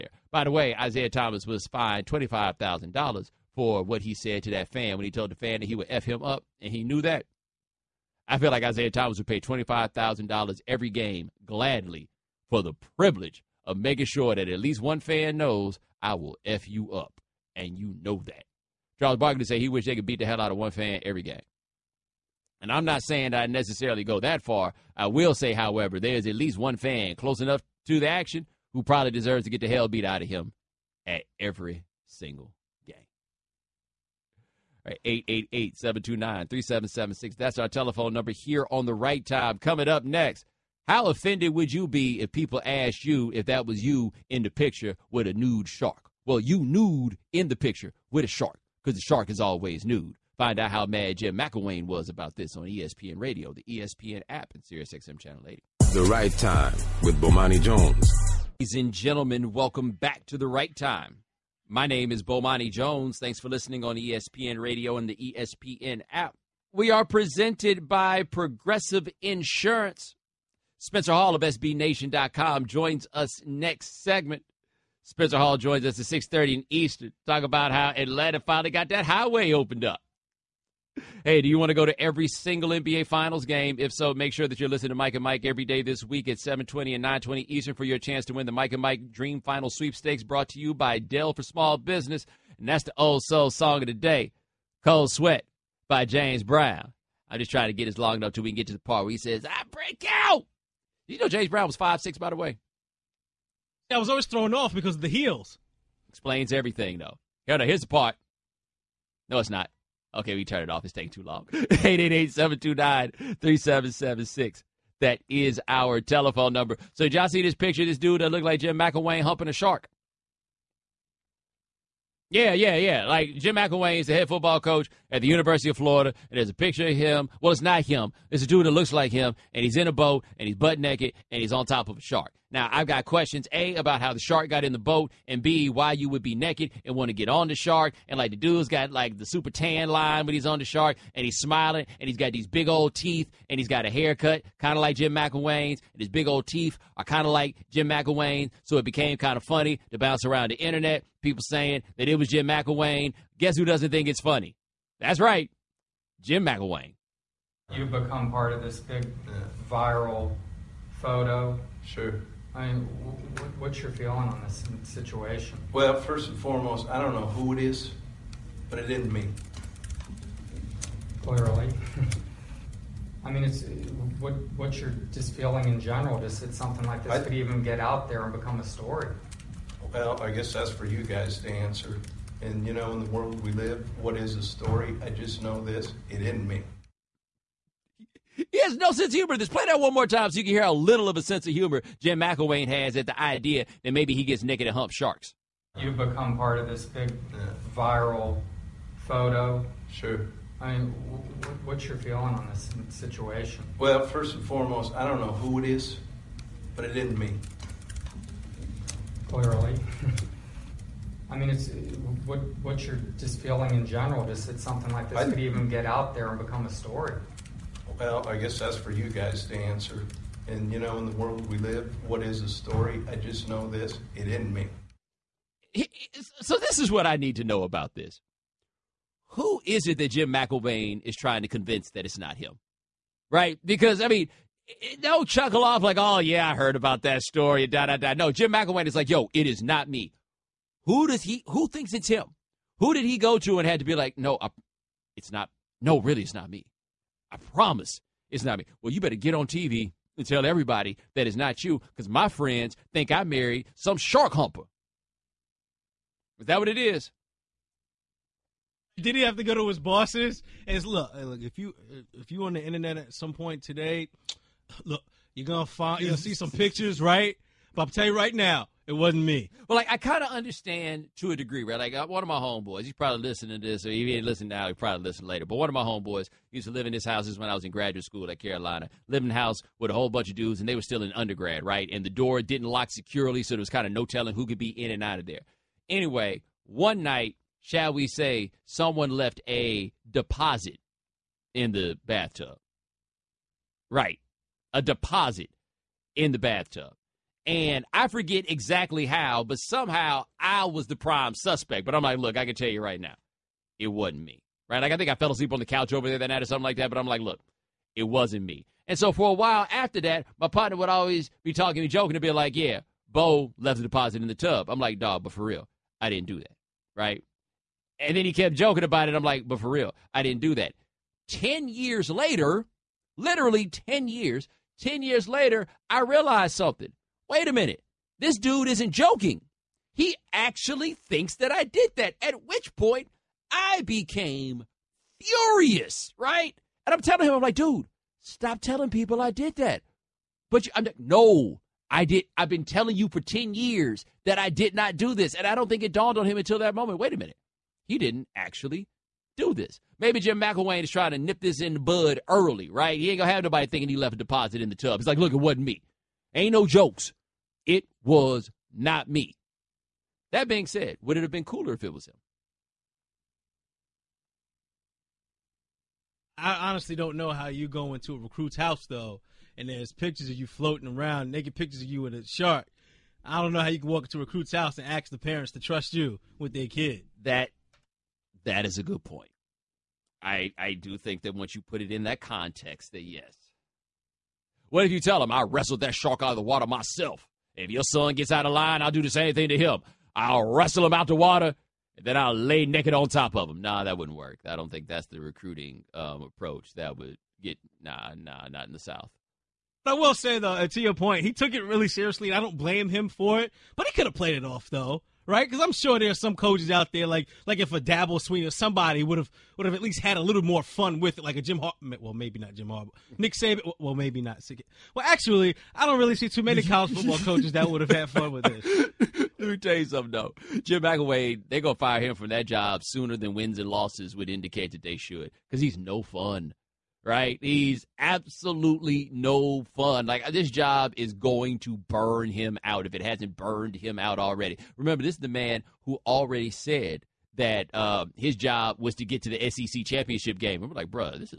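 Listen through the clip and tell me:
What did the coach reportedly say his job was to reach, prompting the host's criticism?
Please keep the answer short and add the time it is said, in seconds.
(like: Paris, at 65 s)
SEC championship game, at 439 s.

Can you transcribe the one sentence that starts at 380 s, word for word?
I I do think that once you put it in that context, that yes.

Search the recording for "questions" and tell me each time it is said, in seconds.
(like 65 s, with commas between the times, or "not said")
133 s.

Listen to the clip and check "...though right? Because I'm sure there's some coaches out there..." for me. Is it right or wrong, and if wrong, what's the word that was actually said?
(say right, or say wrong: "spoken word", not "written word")
right.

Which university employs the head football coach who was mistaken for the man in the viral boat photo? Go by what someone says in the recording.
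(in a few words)
University of Florida.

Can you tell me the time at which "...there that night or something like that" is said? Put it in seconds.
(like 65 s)
306 s.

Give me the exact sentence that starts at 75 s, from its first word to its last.
Spencer Hall joins us at 6.30 in Eastern.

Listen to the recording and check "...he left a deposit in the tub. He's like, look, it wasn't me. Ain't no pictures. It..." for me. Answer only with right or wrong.
wrong.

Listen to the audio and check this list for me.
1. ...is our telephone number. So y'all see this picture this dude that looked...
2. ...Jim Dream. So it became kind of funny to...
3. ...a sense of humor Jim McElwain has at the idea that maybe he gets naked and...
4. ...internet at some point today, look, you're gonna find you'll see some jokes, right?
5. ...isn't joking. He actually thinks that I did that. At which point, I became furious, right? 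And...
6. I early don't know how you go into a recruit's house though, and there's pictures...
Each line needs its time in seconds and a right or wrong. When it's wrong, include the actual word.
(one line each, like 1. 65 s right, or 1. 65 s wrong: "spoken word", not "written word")
1. 115 s right
2. 147 s wrong: "McElwain", not "Dream"
3. 191 s right
4. 262 s wrong: "pictures", not "jokes"
5. 328 s right
6. 366 s wrong: "honestly", not "early".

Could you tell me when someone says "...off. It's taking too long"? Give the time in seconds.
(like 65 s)
110 s.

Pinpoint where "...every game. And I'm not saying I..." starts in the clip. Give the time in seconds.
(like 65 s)
21 s.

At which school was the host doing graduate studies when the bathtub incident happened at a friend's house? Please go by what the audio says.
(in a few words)
Carolina.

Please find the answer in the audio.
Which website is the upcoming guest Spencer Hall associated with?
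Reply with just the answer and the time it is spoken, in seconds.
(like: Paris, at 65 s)
SBNation.com, at 71 s.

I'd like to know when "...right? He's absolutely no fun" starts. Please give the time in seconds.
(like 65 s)
427 s.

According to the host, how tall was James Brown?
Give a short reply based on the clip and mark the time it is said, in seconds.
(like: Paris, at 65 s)
5'6", at 101 s.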